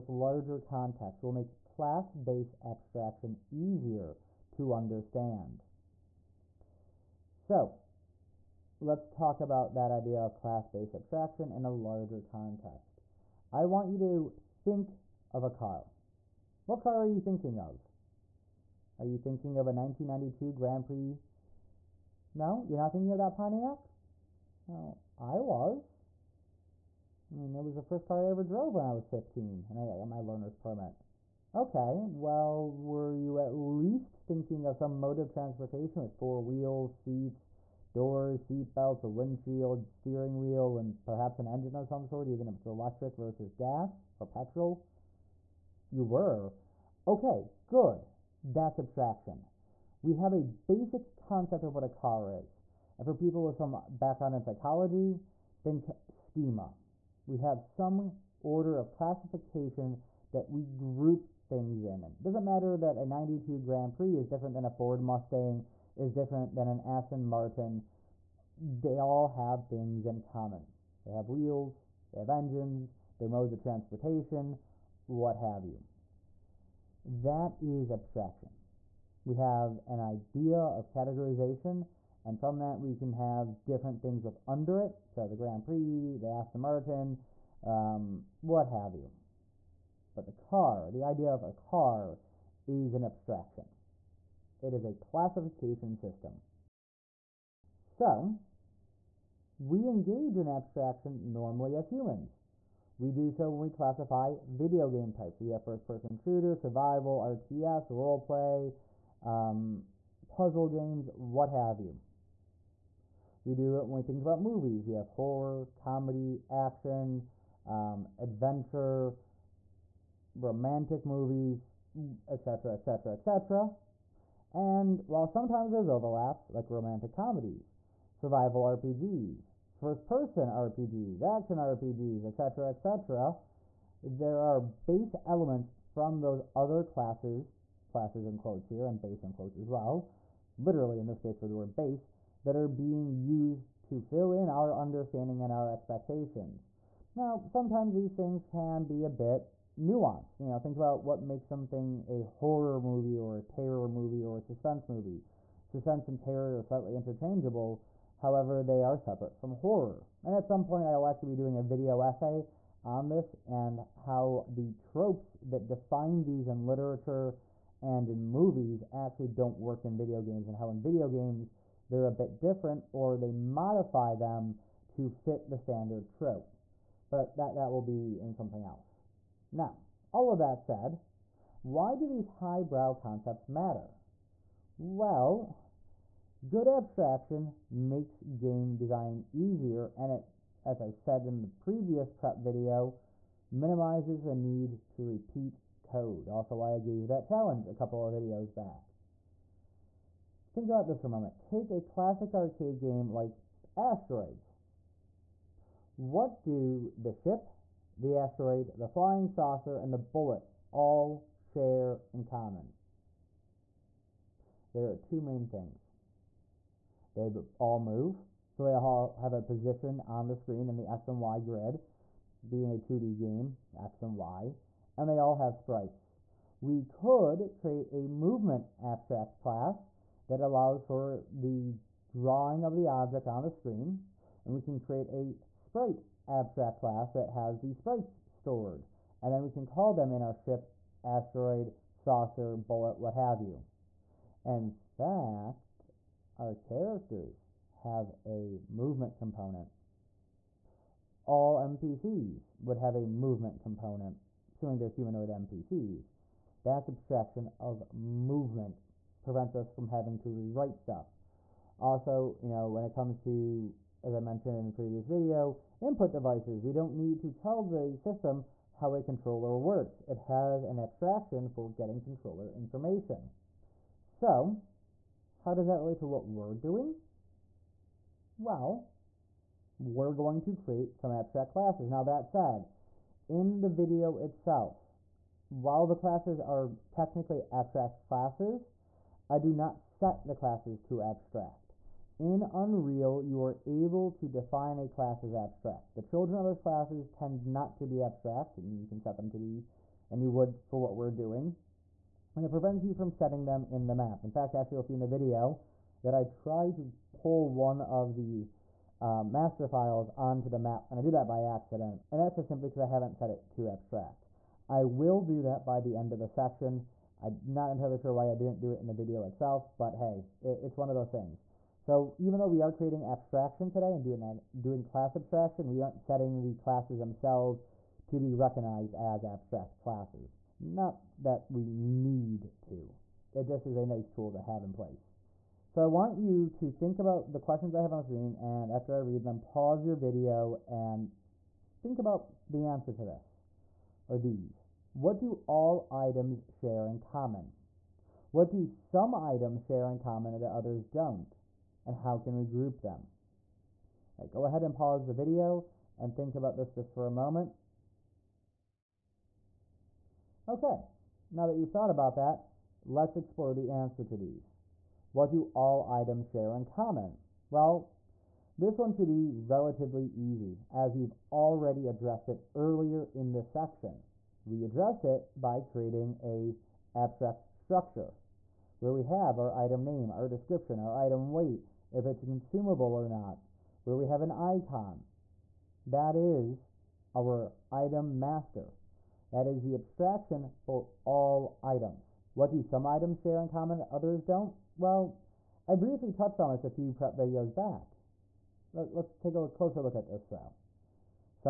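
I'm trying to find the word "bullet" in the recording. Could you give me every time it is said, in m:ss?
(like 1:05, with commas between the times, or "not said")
3:29, 4:02.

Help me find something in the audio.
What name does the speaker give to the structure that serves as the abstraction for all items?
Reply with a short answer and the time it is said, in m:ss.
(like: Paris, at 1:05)
item master, at 6:27.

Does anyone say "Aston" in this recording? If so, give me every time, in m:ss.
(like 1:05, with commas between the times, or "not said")
1:06, 1:26.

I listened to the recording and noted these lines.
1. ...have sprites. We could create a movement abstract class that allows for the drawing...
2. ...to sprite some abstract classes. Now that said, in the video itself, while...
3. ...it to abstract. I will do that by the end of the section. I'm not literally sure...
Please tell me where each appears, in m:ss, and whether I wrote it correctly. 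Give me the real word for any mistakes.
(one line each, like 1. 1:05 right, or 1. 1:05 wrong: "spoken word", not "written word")
1. 3:45 right
2. 4:40 wrong: "create", not "sprite"
3. 5:13 wrong: "entirely", not "literally".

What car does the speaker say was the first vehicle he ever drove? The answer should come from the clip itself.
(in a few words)
1992 Grand Prix.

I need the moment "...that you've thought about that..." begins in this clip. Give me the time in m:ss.
6:01.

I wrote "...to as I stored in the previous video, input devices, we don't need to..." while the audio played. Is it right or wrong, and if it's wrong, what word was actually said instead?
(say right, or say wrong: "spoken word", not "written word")
wrong: "mentioned", not "stored".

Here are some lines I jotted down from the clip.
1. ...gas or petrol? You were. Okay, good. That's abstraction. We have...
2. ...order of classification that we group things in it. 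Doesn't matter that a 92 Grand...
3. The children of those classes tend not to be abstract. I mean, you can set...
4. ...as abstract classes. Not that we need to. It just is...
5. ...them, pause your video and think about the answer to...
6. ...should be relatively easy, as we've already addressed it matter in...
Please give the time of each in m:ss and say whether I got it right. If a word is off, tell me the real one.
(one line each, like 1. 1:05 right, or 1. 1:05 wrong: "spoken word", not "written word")
1. 0:43 right
2. 0:58 right
3. 4:55 right
4. 5:28 right
5. 5:39 right
6. 6:08 wrong: "earlier", not "matter".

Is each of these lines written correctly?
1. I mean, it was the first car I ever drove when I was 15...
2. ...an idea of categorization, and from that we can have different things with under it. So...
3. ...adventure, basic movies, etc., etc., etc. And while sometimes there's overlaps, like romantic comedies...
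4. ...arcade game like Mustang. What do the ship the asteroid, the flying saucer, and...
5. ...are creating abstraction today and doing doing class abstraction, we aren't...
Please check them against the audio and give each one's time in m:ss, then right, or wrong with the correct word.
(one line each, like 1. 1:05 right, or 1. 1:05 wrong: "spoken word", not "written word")
1. 0:27 right
2. 1:19 right
3. 1:58 wrong: "romantic", not "basic"
4. 3:22 wrong: "Asteroids", not "Mustang"
5. 5:22 right.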